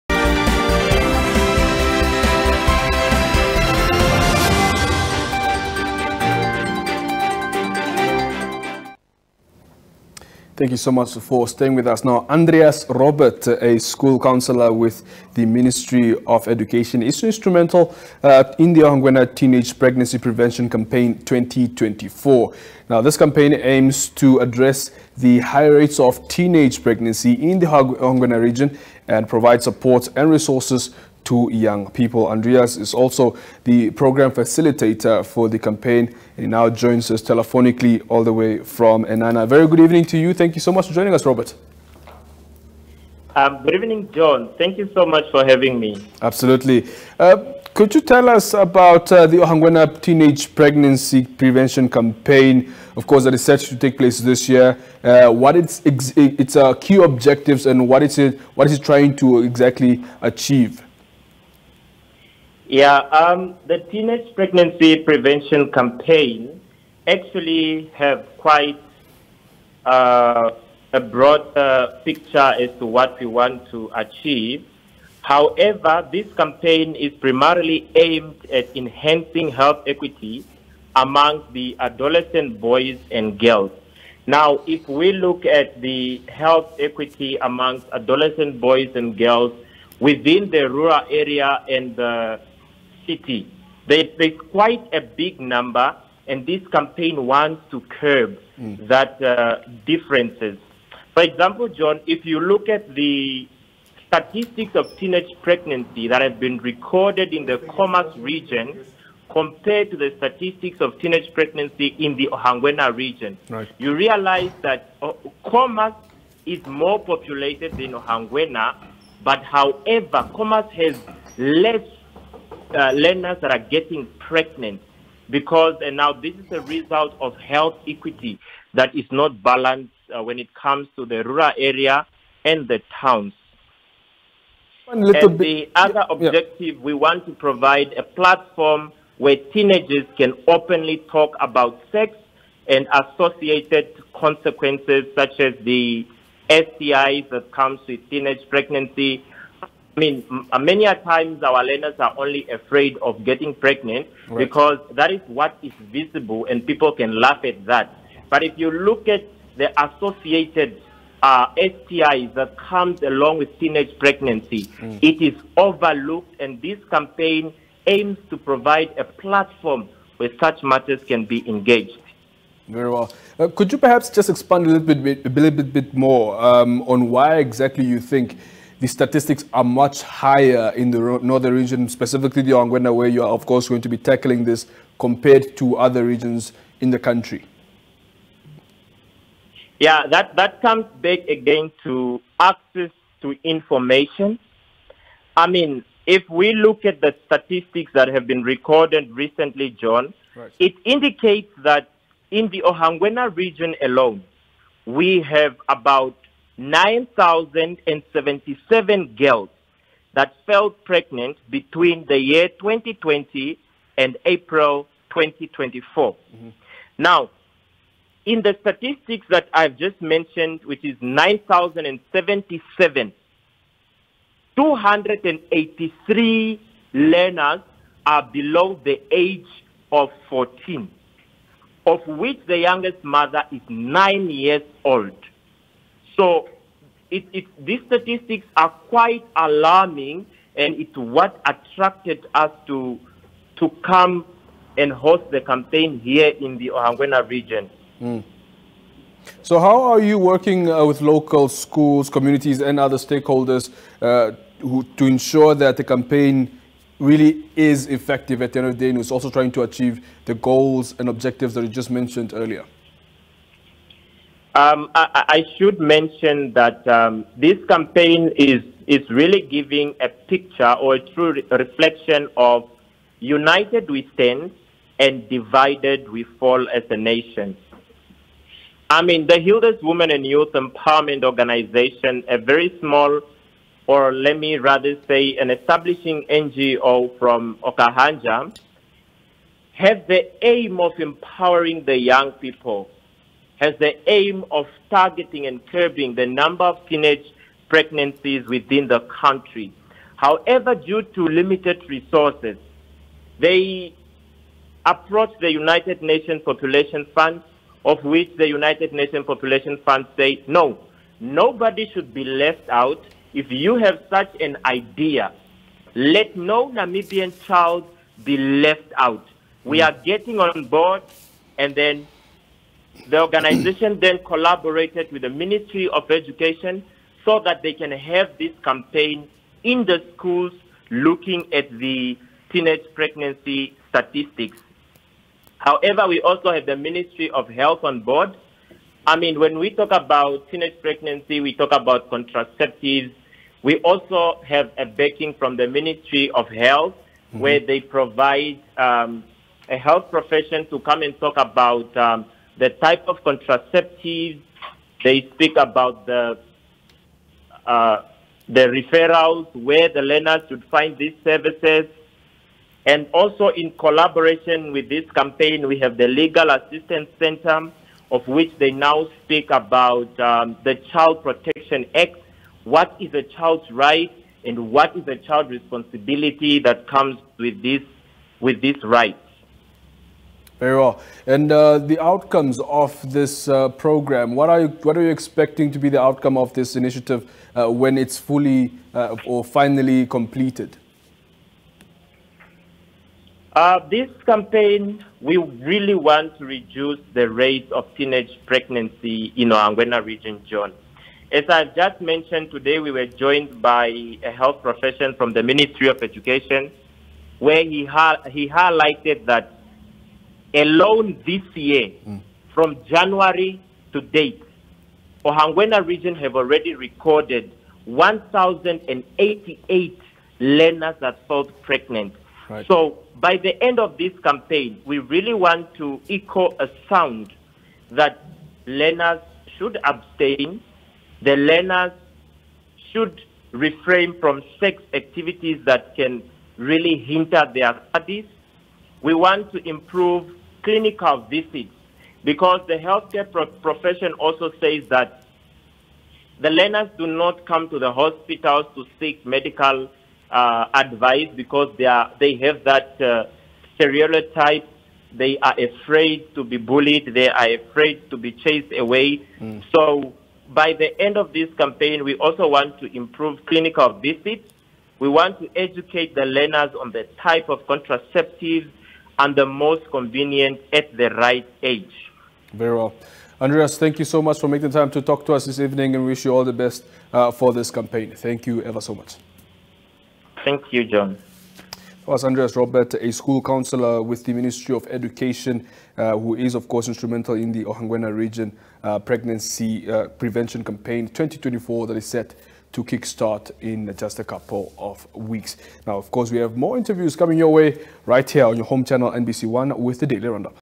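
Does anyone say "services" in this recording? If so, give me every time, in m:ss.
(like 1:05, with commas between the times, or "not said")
6:01.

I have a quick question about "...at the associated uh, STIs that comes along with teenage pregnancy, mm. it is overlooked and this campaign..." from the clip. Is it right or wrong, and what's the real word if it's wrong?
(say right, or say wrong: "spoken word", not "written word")
right.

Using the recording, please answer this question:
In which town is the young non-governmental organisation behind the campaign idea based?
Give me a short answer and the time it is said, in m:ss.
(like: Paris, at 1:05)
Okahandja, at 4:47.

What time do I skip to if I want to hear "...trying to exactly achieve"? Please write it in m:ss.
0:58.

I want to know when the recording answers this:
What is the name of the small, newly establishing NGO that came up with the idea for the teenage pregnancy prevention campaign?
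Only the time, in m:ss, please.
4:39.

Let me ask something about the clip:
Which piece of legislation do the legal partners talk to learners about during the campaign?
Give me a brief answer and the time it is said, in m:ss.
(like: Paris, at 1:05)
Child Protection Act, at 6:10.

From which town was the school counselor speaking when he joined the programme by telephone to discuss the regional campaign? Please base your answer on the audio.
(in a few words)
Eenhana.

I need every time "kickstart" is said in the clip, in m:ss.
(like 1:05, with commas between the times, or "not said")
8:12.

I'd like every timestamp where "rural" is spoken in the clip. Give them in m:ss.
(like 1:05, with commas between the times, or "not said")
1:30, 2:11.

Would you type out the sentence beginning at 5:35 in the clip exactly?
However, we also have the Ministry of Health on board.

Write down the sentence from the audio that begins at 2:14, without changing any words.
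And bit, the other objective, yeah.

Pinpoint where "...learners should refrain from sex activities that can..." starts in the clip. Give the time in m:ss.
7:11.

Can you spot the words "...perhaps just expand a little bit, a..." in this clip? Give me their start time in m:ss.
2:53.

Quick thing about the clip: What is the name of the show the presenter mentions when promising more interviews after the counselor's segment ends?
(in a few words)
Daily Roundup.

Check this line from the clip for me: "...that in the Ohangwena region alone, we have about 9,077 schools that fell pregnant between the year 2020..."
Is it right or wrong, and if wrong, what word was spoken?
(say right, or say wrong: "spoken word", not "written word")
wrong: "girls", not "schools".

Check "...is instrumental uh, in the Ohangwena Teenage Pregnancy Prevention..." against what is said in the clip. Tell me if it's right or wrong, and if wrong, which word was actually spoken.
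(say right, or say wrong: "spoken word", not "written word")
right.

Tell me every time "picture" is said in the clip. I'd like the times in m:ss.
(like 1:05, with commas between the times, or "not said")
1:12, 4:30.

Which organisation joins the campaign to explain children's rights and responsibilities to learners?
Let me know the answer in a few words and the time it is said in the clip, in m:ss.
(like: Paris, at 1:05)
Legal Assistance Center, at 6:06.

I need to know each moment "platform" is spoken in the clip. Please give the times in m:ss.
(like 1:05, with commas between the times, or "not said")
2:18, 2:49.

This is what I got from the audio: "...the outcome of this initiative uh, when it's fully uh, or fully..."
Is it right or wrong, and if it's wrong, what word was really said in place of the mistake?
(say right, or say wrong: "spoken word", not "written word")
wrong: "finally", not "fully".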